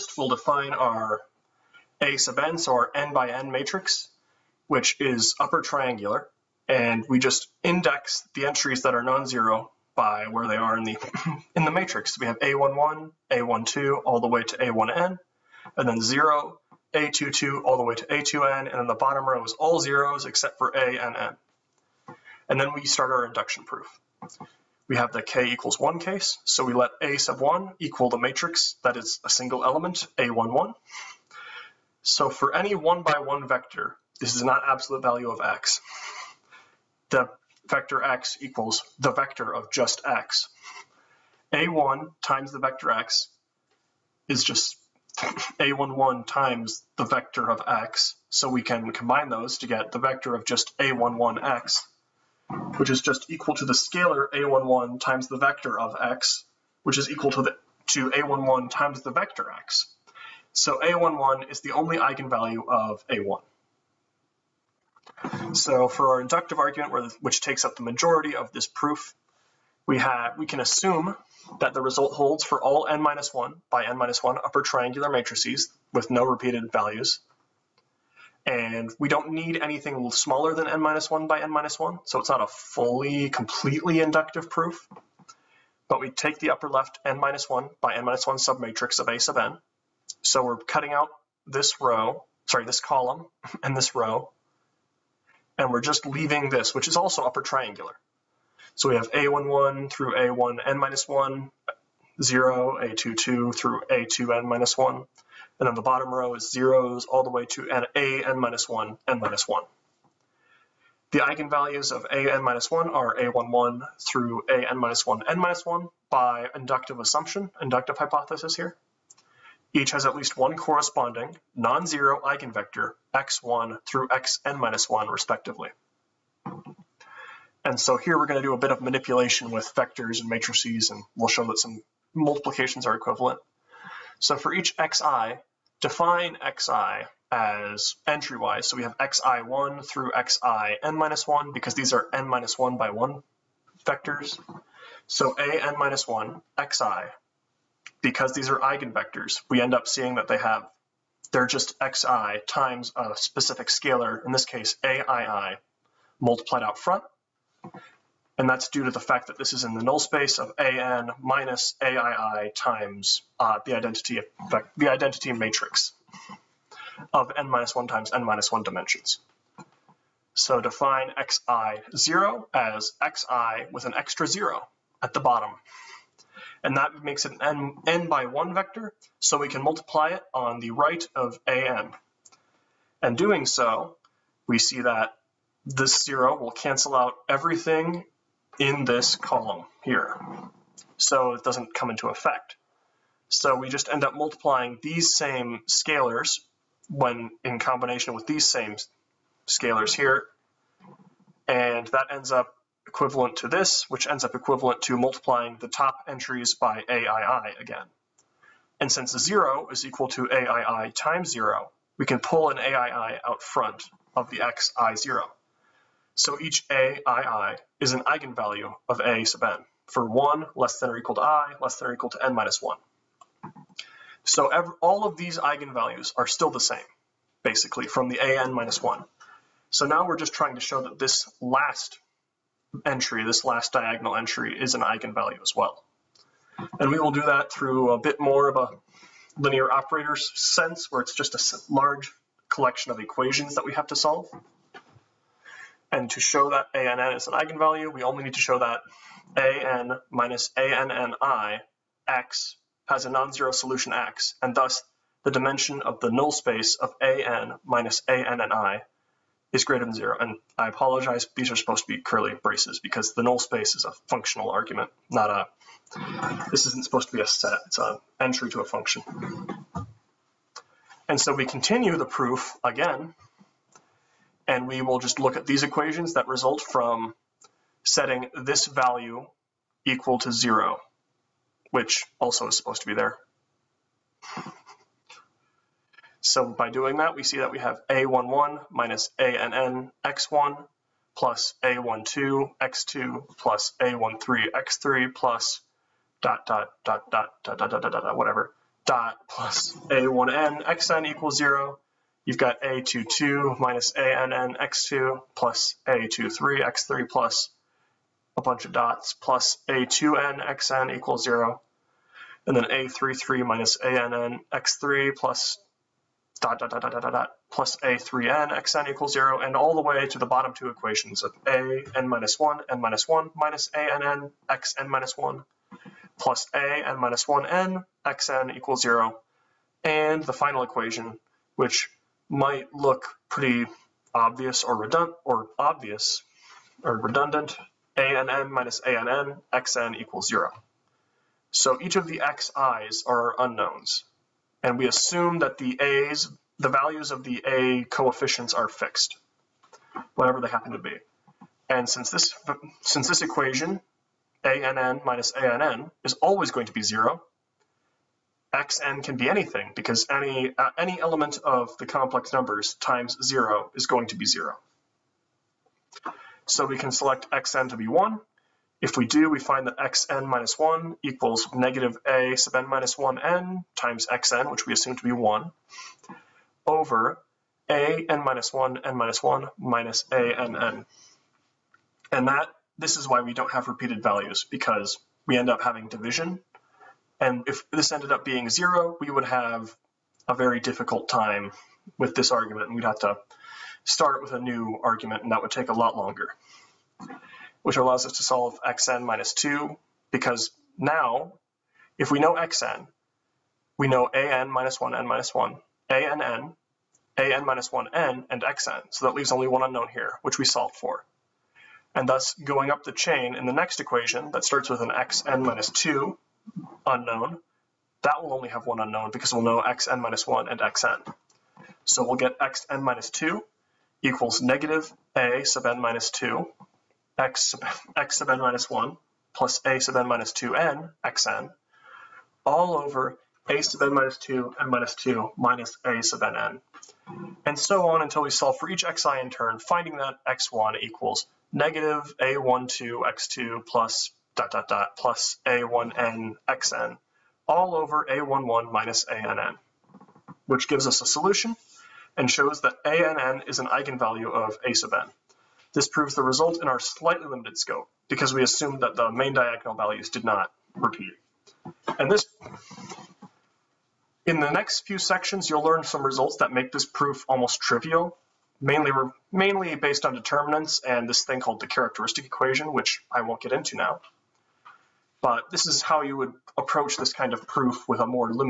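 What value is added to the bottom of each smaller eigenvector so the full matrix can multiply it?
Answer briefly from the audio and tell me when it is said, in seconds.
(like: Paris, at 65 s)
0, at 173 s.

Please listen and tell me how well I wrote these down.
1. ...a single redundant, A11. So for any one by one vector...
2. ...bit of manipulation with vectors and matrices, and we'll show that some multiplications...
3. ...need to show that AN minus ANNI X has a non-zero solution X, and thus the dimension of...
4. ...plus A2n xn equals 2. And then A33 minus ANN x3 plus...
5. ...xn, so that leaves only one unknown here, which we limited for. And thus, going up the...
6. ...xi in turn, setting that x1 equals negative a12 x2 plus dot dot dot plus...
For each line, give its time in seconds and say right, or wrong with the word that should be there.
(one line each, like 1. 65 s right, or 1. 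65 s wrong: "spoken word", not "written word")
1. 29 s wrong: "element", not "redundant"
2. 128 s right
3. 248 s right
4. 309 s wrong: "0", not "2"
5. 408 s wrong: "solved", not "limited"
6. 438 s wrong: "finding", not "setting".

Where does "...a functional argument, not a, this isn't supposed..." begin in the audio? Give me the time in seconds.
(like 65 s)
263 s.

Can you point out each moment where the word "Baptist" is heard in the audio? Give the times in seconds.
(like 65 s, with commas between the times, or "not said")
not said.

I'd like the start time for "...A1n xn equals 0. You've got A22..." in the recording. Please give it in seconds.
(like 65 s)
299 s.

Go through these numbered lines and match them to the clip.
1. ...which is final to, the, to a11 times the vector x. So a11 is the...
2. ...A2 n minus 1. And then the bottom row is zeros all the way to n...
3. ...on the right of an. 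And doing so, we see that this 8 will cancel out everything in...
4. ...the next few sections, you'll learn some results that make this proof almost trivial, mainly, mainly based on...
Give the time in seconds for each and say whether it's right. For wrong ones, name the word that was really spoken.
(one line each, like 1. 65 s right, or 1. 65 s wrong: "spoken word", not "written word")
1. 56 s wrong: "equal", not "final"
2. 103 s right
3. 180 s wrong: "0", not "8"
4. 464 s right.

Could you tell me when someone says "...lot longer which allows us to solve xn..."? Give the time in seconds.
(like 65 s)
395 s.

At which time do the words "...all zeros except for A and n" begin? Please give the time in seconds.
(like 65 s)
19 s.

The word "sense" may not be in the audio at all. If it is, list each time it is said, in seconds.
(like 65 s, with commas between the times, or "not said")
240 s.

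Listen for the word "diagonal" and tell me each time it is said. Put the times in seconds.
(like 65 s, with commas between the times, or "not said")
233 s, 459 s.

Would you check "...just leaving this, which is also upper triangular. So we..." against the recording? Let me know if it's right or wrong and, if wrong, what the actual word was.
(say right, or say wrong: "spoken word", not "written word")
right.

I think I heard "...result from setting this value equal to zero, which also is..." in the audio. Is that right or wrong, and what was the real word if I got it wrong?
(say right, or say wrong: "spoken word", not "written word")
right.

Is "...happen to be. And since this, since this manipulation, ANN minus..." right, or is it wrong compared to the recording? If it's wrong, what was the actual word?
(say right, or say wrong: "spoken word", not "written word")
wrong: "equation", not "manipulation".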